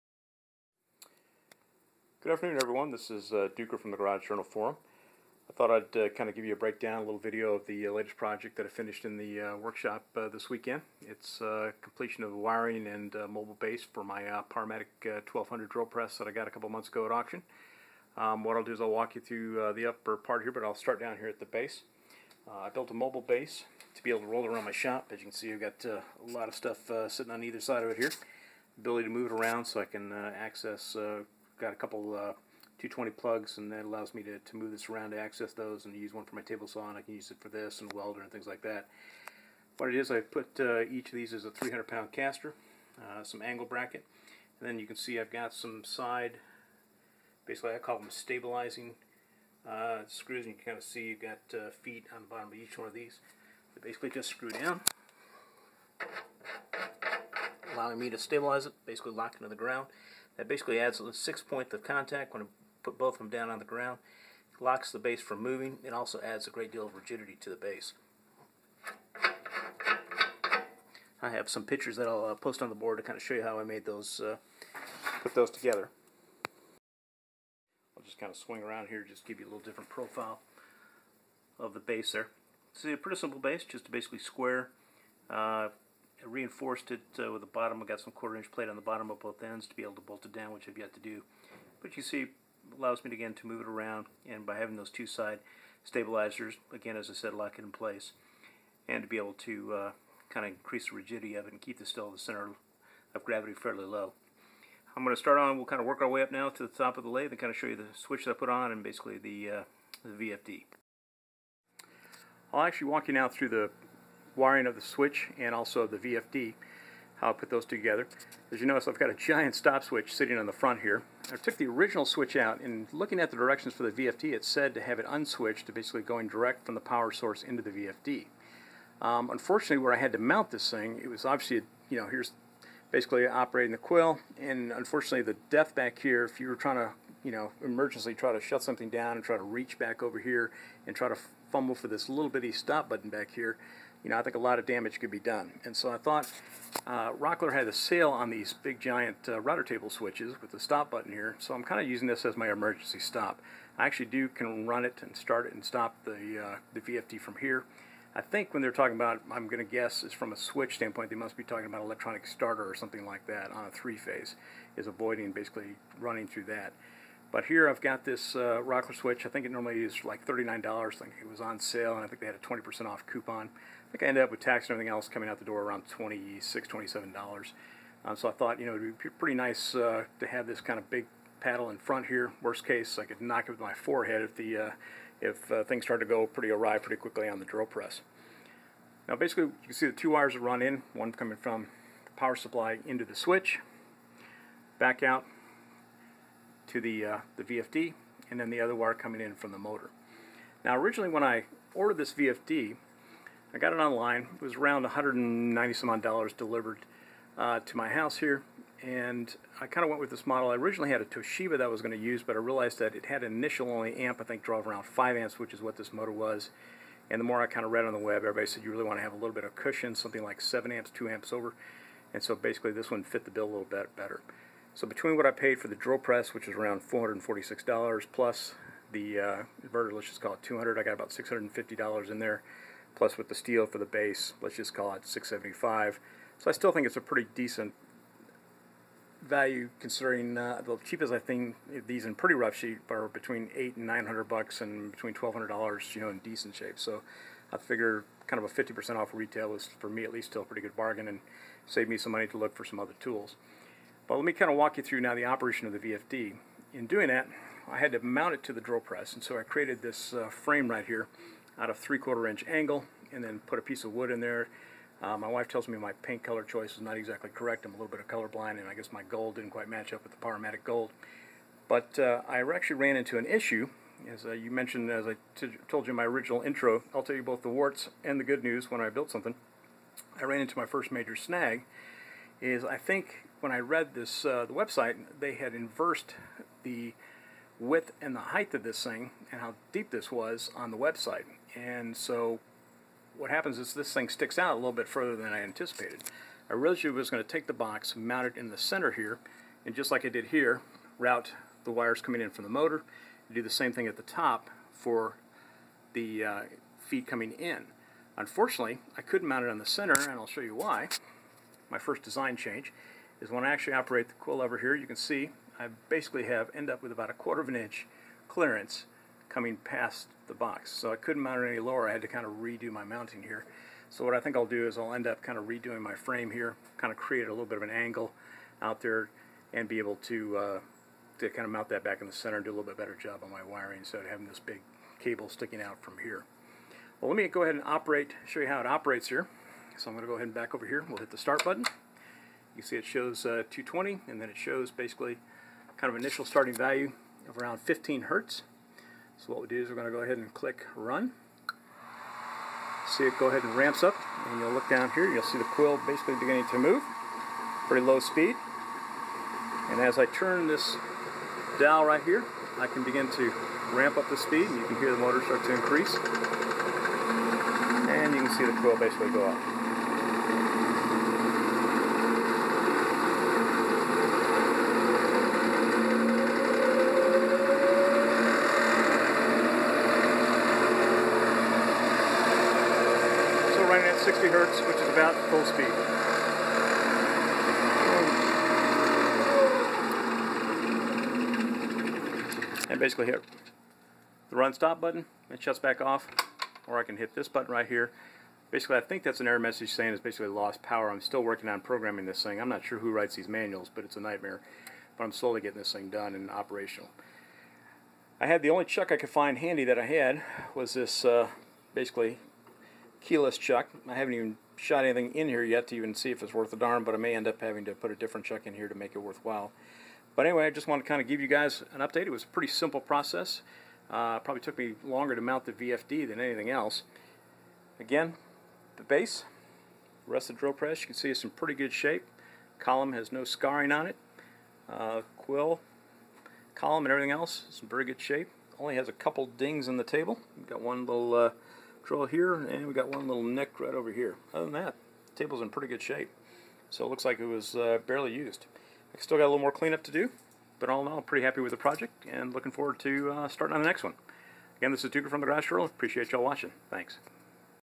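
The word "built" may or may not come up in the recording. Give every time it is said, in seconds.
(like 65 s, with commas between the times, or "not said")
22 s, 278 s.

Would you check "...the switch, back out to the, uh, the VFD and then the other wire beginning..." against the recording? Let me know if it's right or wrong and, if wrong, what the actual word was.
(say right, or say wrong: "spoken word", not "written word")
wrong: "coming", not "beginning".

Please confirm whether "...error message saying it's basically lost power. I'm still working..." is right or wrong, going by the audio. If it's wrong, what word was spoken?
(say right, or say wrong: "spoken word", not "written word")
right.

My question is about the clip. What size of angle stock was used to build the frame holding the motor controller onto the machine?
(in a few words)
three-quarter inch.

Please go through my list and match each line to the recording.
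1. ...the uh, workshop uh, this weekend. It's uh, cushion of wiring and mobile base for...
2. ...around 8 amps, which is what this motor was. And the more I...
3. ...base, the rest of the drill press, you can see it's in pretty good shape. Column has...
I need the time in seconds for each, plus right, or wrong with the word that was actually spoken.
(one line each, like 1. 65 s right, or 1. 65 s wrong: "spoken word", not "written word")
1. 9 s wrong: "completion", not "cushion"
2. 214 s wrong: "5", not "8"
3. 428 s right.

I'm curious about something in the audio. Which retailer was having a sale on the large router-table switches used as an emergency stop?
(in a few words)
Rockler.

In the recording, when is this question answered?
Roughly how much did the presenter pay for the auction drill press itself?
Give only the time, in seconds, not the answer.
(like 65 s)
226 s.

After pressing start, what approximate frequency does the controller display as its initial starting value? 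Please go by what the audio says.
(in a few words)
15 hertz.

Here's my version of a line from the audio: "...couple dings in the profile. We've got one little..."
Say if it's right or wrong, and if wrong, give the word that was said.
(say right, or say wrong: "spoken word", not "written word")
wrong: "table", not "profile".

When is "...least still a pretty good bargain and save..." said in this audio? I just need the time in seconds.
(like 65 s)
250 s.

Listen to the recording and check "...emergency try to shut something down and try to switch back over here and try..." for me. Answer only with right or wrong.
wrong.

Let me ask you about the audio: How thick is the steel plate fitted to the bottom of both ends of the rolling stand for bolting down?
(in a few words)
quarter inch.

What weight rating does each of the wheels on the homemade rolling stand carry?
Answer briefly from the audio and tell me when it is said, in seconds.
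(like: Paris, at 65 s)
300 pound, at 41 s.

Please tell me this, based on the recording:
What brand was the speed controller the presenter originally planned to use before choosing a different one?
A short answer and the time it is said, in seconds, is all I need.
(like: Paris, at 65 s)
Toshiba, at 211 s.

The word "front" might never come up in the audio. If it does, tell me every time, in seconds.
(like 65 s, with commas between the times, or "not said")
120 s, 181 s.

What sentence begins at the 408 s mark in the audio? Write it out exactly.
I had the only chuck I could find handy that I had was this uh, basically keyless chuck.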